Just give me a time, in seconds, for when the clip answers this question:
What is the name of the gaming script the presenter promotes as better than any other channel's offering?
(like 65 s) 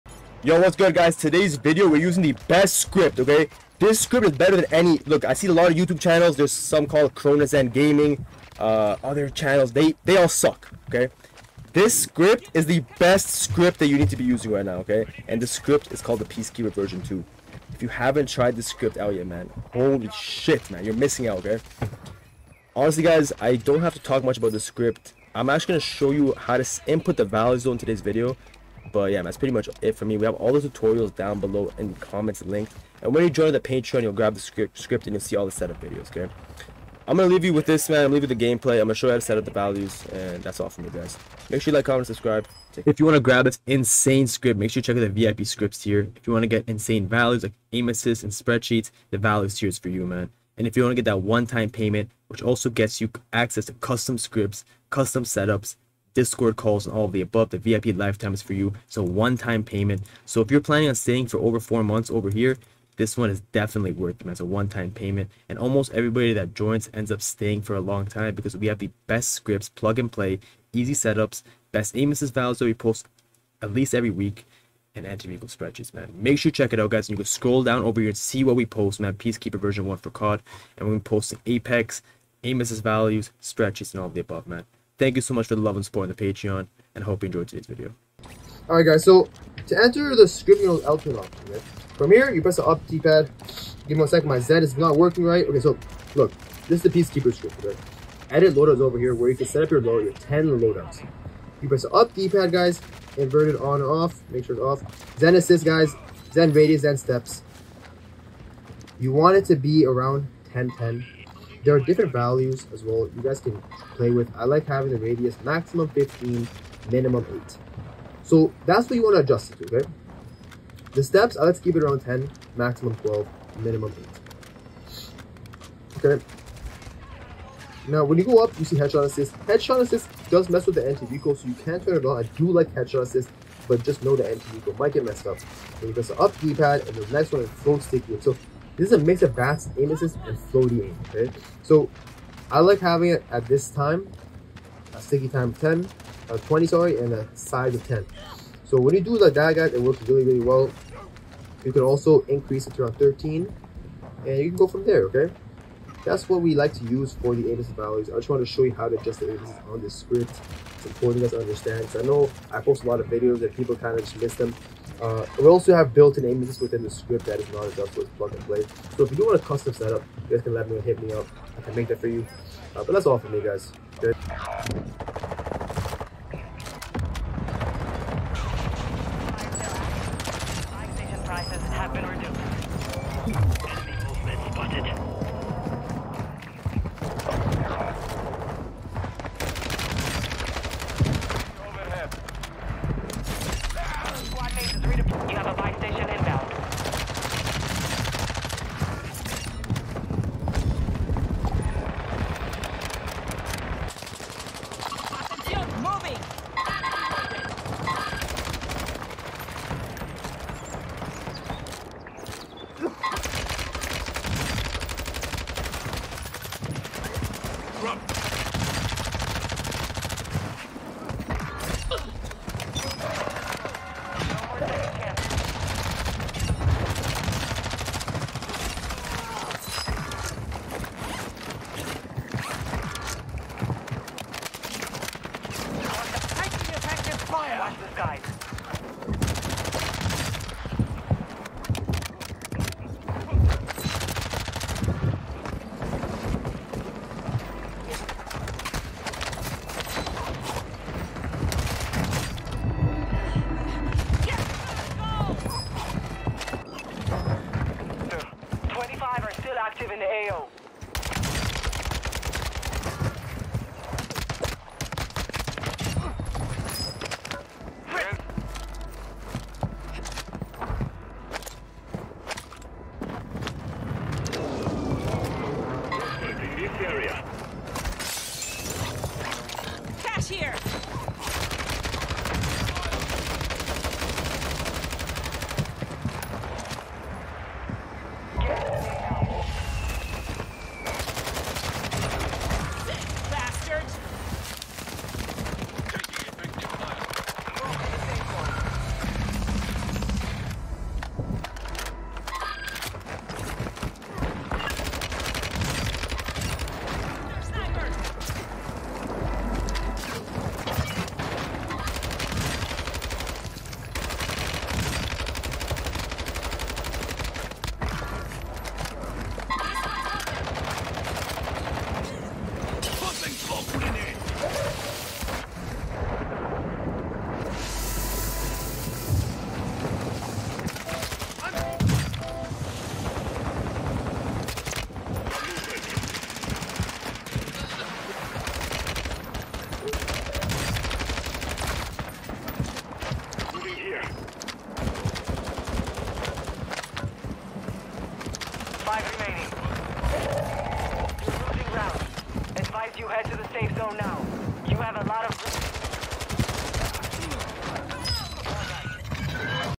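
16 s.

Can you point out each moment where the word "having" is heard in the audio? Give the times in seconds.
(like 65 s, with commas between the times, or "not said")
114 s, 142 s.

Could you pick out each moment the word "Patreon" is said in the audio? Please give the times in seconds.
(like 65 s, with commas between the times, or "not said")
33 s, 86 s.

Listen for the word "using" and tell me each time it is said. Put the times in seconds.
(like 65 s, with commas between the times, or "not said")
1 s, 14 s.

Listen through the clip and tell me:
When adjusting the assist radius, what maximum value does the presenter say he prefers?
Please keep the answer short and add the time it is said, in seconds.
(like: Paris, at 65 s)
15, at 115 s.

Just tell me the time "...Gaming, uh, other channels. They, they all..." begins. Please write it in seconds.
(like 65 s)
7 s.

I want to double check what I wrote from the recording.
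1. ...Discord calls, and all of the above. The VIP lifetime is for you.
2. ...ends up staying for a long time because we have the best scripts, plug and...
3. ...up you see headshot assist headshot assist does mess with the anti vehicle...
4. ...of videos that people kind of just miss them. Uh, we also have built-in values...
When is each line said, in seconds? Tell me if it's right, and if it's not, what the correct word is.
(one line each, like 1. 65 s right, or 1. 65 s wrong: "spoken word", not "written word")
1. 56 s right
2. 66 s right
3. 128 s right
4. 162 s wrong: "images", not "values".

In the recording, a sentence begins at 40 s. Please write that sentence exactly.
And that's all from me, guys.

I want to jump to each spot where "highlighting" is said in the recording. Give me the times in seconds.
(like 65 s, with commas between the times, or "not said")
not said.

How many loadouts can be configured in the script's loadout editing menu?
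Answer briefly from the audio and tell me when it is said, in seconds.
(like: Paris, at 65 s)
10, at 100 s.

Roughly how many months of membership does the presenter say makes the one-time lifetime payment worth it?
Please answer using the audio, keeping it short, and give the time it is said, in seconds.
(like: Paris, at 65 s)
4, at 61 s.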